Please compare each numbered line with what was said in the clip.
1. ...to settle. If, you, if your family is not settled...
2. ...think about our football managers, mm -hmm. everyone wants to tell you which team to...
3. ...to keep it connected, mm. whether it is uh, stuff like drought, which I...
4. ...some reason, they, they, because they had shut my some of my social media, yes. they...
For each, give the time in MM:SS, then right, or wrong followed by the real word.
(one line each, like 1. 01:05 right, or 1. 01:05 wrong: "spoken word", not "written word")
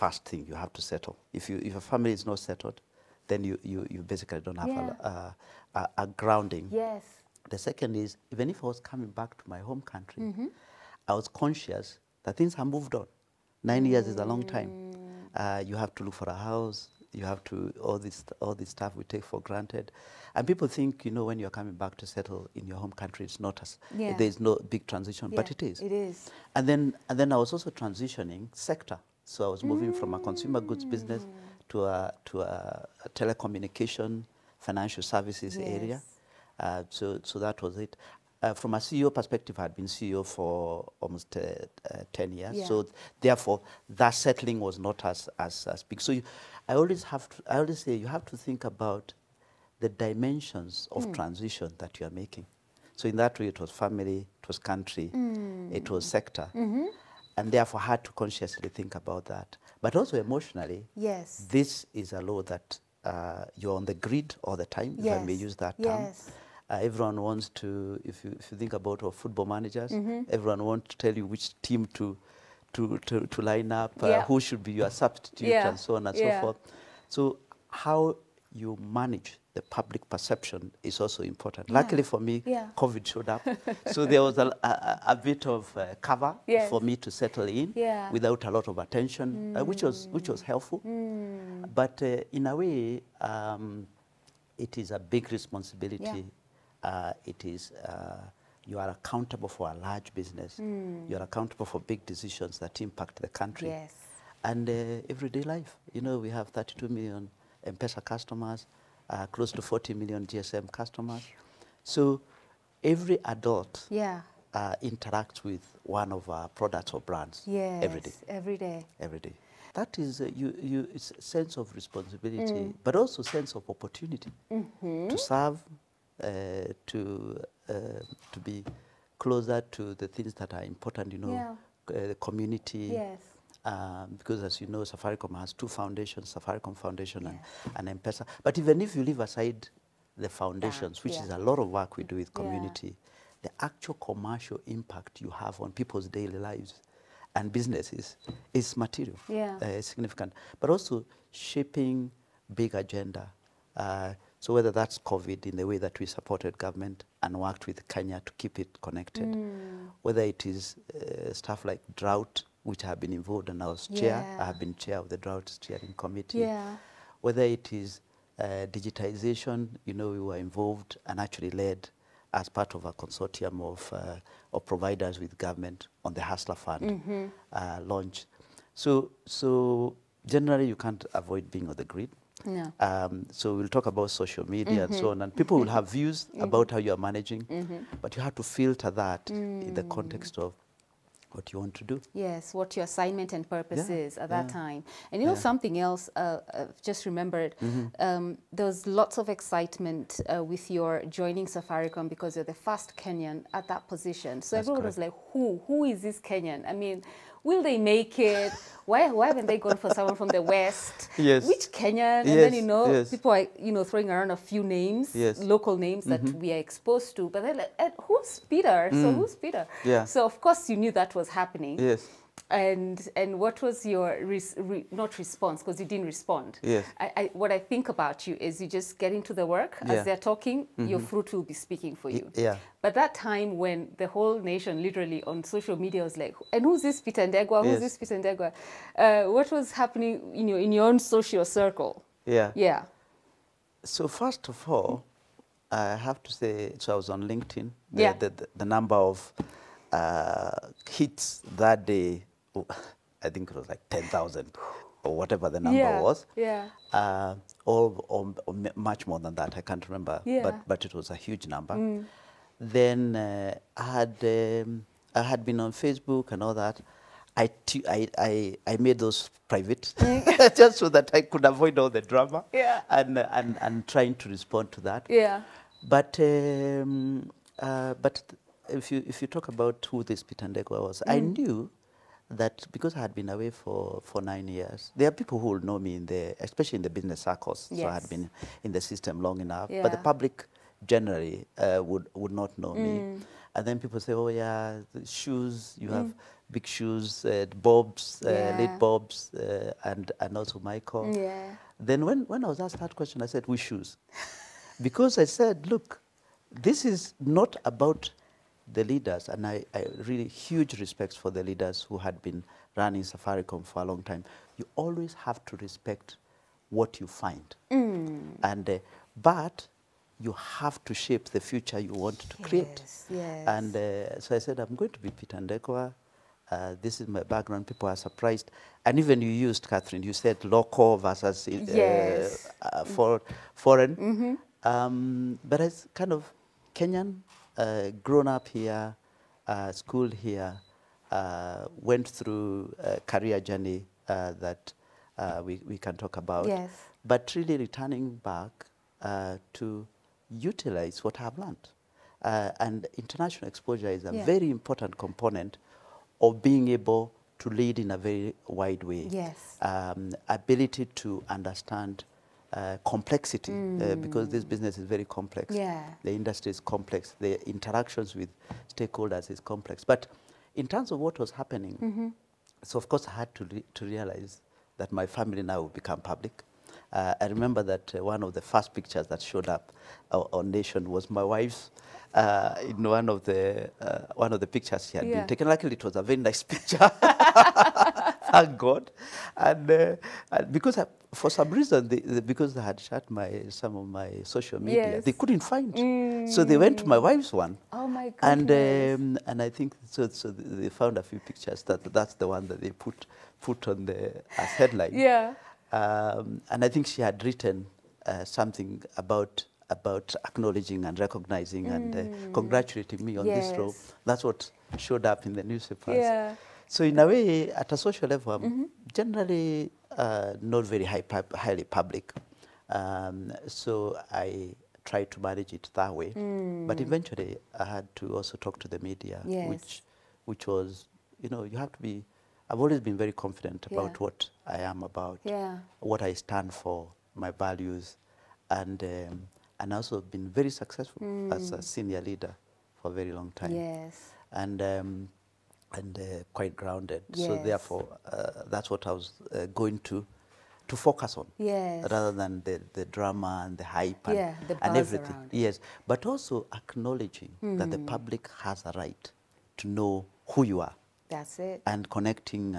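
1. 00:00 right
2. 01:08 right
3. 02:38 right
4. 06:31 right.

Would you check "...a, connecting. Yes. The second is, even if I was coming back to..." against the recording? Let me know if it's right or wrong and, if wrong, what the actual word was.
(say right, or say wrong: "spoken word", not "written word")
wrong: "grounding", not "connecting".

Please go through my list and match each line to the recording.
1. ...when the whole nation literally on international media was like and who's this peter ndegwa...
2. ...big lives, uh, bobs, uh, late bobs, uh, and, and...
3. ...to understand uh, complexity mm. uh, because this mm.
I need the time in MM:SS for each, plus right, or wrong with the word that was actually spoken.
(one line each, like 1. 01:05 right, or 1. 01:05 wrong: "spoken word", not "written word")
1. 03:53 wrong: "social", not "international"
2. 04:56 wrong: "shoes", not "lives"
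3. 06:00 right.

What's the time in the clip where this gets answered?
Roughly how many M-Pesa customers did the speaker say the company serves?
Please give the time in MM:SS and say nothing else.
01:46.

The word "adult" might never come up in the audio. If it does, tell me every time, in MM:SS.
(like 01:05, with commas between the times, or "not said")
01:53.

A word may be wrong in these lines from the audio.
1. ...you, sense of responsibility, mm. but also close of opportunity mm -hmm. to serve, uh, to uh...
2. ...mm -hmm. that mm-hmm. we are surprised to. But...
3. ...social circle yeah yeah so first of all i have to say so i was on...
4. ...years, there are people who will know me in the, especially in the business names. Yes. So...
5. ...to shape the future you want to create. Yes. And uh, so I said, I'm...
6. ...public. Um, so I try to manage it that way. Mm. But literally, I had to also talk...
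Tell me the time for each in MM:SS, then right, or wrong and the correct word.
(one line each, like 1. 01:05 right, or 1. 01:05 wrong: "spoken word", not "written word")
1. 02:00 wrong: "sense", not "close"
2. 03:36 wrong: "exposed", not "surprised"
3. 04:00 right
4. 04:44 wrong: "circles", not "names"
5. 05:20 right
6. 07:01 wrong: "eventually", not "literally".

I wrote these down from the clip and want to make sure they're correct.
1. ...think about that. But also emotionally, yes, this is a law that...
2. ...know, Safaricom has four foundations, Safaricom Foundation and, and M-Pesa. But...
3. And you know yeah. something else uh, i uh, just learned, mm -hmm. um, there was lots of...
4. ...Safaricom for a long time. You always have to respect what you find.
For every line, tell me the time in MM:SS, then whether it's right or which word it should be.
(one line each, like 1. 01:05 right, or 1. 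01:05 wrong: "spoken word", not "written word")
1. 00:58 right
2. 02:14 wrong: "two", not "four"
3. 03:15 wrong: "remembered", not "learned"
4. 05:13 right.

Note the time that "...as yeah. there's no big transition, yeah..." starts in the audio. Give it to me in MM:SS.
00:23.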